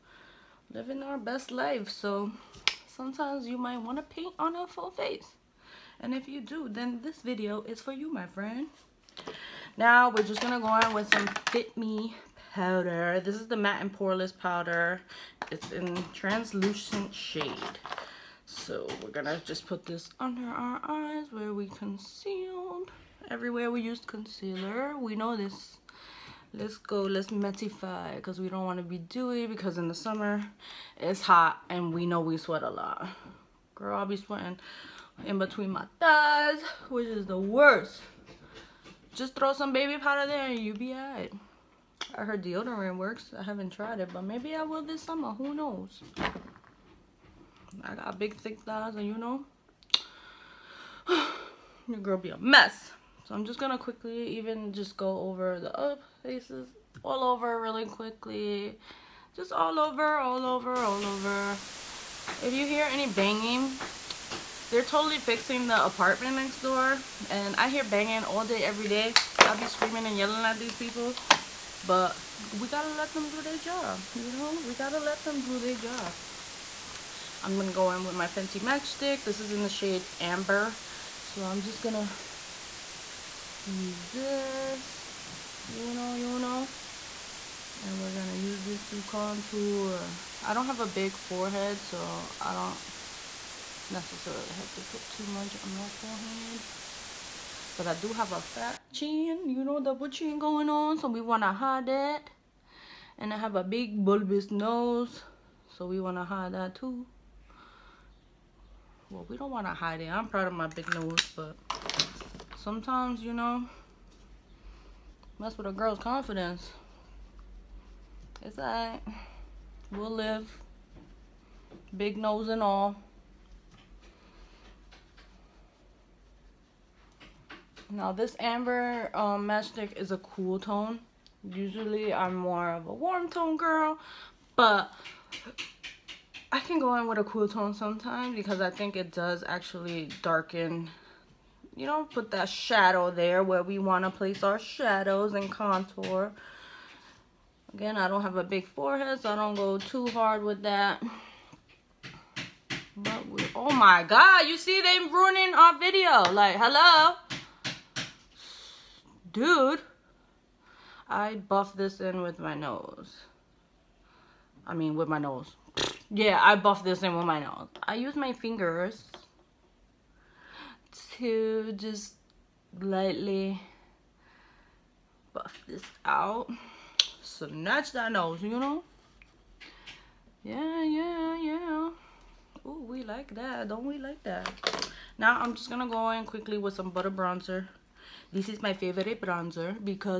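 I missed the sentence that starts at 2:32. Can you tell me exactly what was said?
But we, oh my God, you see they ruining our video.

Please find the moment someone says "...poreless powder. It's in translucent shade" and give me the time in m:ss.
0:13.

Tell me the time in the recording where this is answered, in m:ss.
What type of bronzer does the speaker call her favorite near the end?
3:06.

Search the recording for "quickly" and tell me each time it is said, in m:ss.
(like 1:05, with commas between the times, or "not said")
0:53, 0:57, 3:06.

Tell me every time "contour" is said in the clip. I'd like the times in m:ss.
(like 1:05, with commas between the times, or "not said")
1:29, 2:25.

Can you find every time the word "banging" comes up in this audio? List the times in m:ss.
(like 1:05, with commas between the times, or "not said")
1:03, 1:07.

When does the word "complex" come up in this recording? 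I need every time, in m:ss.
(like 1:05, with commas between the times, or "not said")
not said.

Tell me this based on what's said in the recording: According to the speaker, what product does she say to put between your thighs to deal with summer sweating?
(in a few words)
Baby powder.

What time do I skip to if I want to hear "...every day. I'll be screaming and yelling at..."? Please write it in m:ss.
1:08.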